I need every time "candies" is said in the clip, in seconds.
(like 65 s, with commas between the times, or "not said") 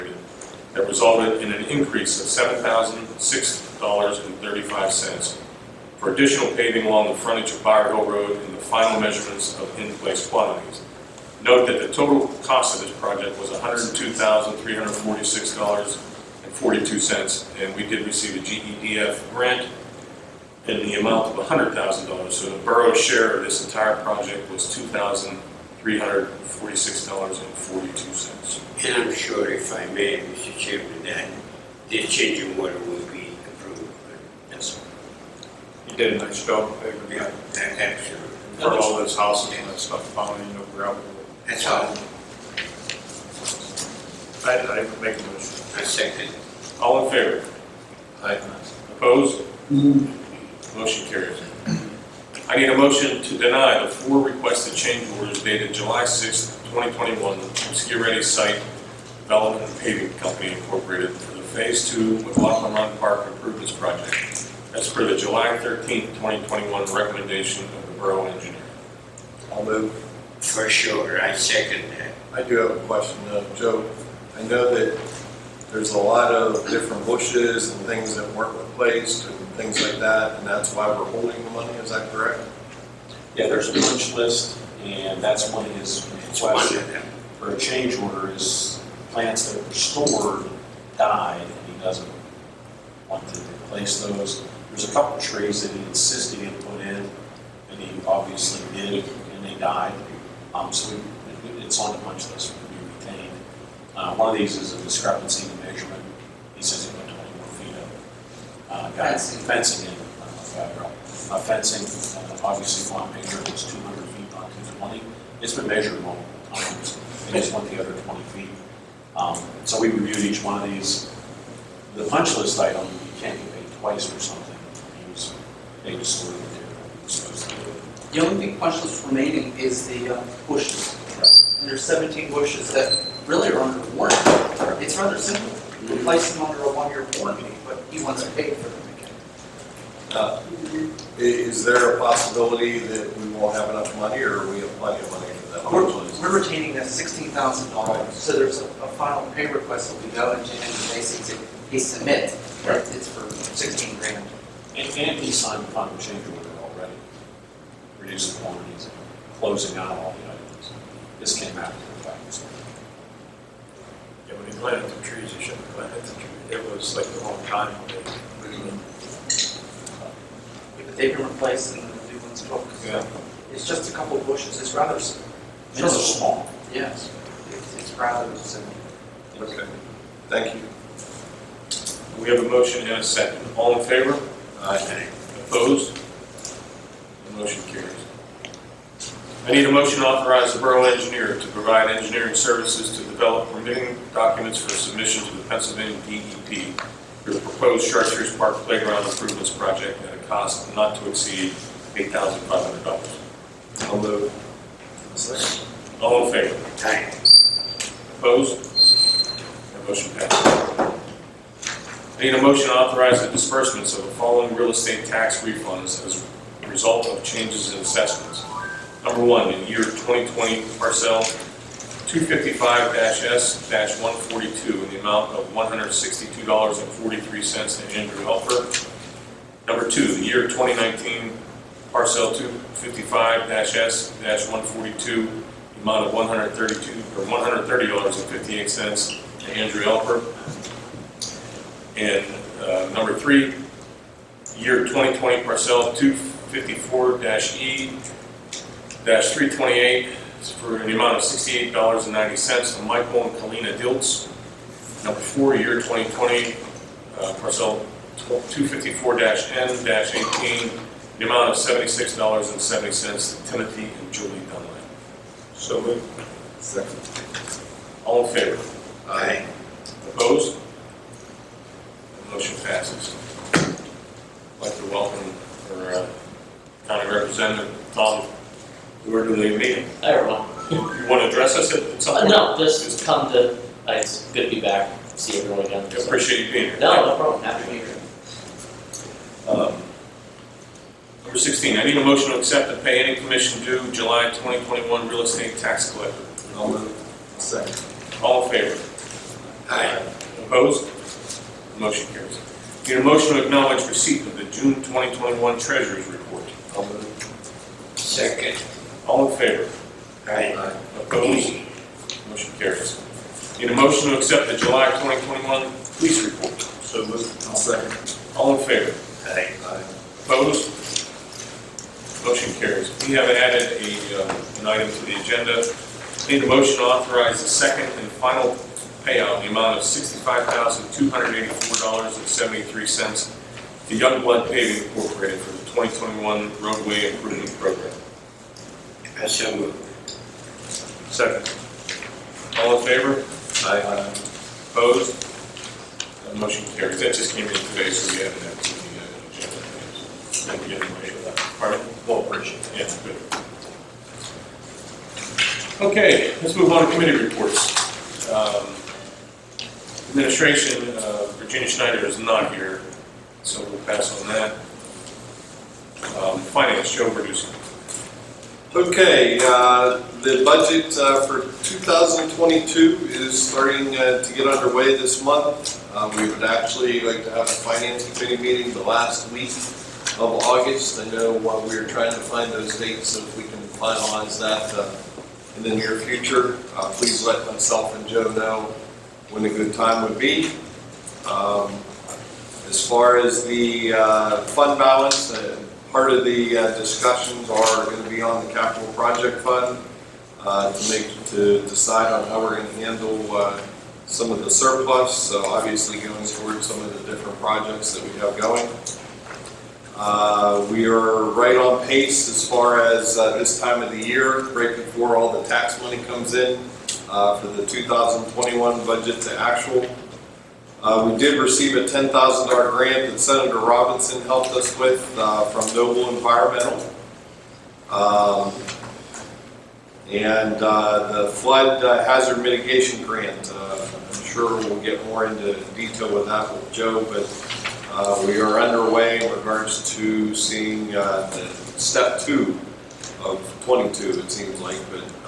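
not said.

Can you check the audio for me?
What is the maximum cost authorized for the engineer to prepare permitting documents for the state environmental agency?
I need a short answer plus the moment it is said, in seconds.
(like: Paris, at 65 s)
$8,500, at 201 s.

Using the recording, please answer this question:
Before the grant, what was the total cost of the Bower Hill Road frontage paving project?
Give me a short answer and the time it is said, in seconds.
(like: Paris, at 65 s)
$102,346.42, at 13 s.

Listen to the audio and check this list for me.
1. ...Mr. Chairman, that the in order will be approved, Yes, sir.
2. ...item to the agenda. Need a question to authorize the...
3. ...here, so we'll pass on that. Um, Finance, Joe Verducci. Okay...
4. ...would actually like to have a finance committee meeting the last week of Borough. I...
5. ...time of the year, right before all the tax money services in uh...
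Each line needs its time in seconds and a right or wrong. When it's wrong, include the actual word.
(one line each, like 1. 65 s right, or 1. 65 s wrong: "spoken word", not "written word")
1. 30 s right
2. 324 s wrong: "motion", not "question"
3. 362 s right
4. 376 s wrong: "August", not "Borough"
5. 413 s wrong: "comes", not "services".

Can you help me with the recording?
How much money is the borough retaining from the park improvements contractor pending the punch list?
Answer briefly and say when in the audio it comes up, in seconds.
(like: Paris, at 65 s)
$16,000, at 146 s.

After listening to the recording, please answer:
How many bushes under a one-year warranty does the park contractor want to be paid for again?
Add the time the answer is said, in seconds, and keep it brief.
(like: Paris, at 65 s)
17, at 131 s.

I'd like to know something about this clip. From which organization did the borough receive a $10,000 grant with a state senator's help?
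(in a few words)
Noble Environmental.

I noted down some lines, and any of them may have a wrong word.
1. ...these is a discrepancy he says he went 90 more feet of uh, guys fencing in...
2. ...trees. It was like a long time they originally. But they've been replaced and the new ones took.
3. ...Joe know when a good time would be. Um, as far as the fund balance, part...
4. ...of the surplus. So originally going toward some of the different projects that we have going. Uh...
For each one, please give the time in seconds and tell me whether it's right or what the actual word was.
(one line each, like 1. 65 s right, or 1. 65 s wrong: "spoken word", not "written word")
1. 104 s wrong: "20", not "90"
2. 166 s right
3. 388 s right
4. 404 s wrong: "obviously", not "originally".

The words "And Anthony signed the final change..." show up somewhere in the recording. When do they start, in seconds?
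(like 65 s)
154 s.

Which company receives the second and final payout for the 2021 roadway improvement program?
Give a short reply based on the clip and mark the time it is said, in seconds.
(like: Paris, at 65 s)
Youngblood Paving, at 333 s.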